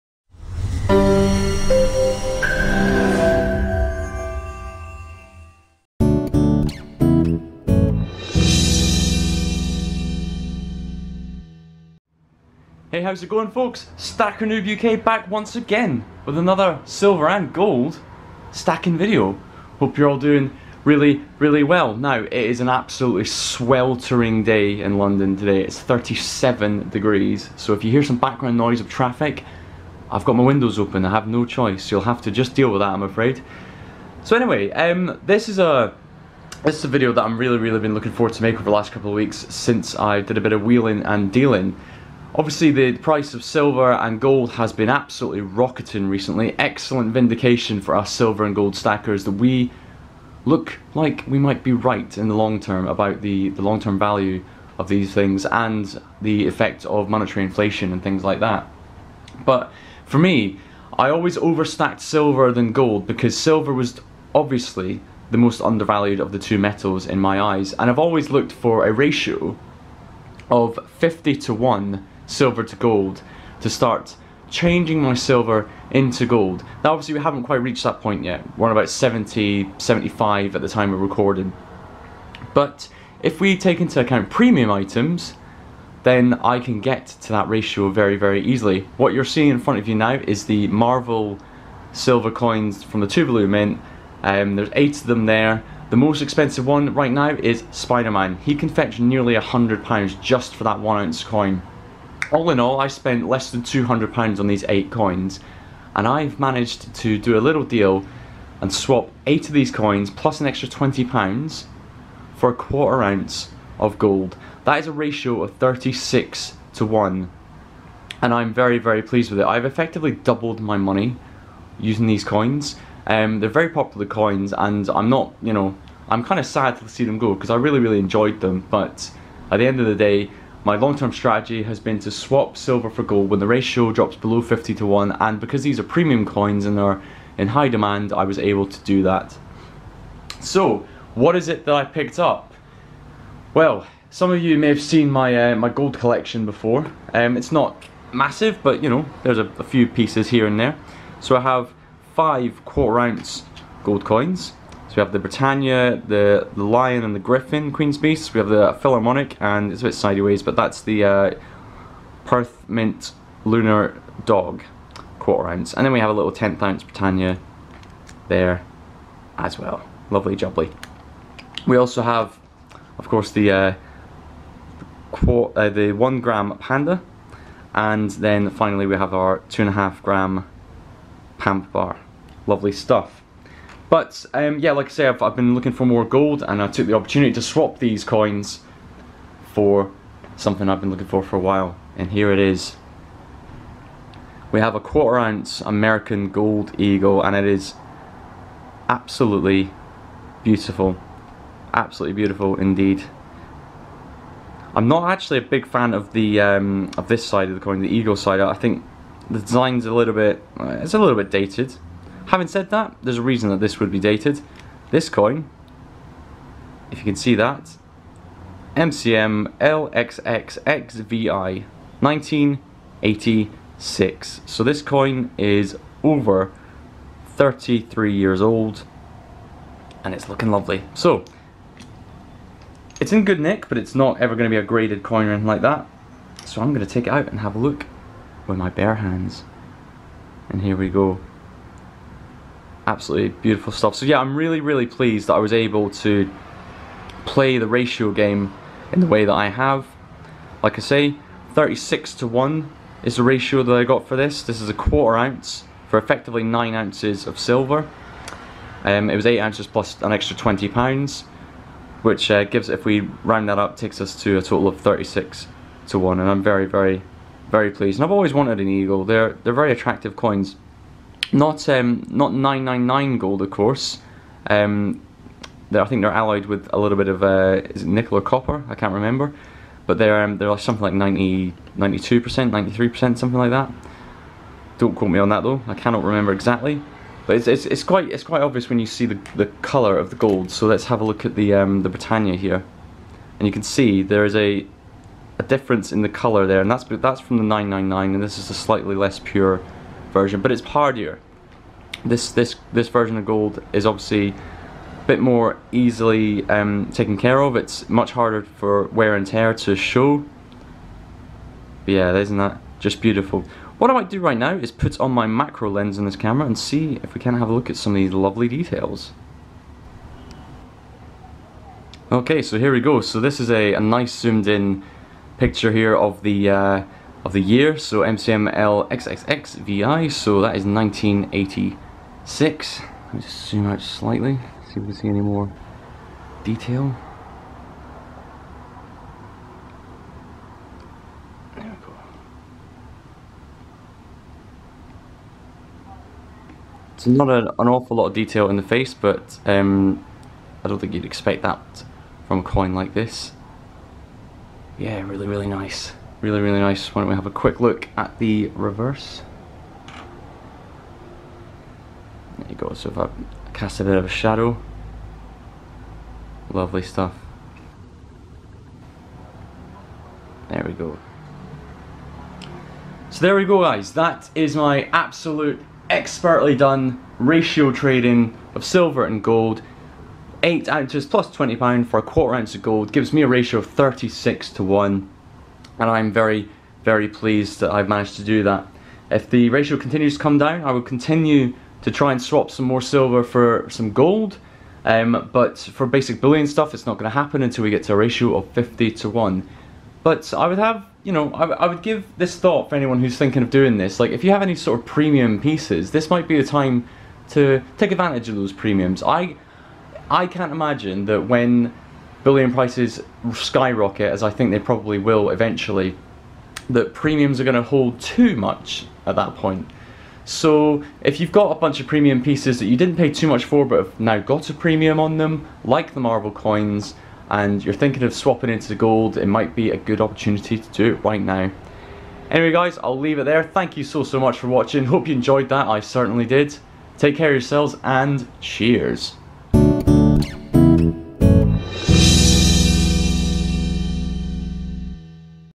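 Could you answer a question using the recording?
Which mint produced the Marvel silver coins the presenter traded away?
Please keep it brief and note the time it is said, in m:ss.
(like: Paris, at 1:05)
Tuvalu Mint, at 1:33.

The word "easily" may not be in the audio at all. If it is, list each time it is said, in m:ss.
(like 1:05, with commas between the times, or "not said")
1:28, 5:05.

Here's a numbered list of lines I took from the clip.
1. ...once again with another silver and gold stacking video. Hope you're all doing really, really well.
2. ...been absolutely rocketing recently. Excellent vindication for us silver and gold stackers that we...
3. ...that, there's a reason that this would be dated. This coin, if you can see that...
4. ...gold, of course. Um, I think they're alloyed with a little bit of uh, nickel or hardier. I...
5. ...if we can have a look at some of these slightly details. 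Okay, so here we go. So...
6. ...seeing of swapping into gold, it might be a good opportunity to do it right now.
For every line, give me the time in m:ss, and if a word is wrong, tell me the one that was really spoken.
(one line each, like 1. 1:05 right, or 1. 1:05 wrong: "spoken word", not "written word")
1. 0:15 right
2. 0:44 right
3. 3:32 right
4. 4:33 wrong: "copper", not "hardier"
5. 5:17 wrong: "lovely", not "slightly"
6. 7:07 wrong: "thinking", not "seeing".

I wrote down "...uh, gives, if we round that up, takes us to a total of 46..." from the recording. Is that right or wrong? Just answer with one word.
wrong.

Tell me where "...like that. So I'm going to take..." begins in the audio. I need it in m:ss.
3:55.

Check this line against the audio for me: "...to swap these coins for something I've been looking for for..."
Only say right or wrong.
right.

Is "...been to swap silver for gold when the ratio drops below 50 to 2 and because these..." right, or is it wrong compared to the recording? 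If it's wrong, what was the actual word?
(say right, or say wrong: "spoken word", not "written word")
wrong: "1", not "2".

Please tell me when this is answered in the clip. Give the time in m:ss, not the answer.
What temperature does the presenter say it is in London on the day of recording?
0:25.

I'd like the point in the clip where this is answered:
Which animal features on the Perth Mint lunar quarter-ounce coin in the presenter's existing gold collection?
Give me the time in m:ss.
2:44.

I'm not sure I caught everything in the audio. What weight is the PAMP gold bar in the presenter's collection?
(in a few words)
2.5 grams.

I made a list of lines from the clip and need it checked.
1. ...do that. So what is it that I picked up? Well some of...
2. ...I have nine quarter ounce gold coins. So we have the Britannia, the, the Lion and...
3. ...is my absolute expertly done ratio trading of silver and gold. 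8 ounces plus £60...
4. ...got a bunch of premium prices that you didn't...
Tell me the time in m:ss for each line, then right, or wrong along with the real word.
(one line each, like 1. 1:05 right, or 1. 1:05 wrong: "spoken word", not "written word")
1. 2:18 right
2. 2:31 wrong: "five", not "nine"
3. 6:14 wrong: "20", not "60"
4. 7:01 wrong: "pieces", not "prices".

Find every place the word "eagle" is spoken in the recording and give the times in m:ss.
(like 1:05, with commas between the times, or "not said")
3:16, 3:27, 4:28.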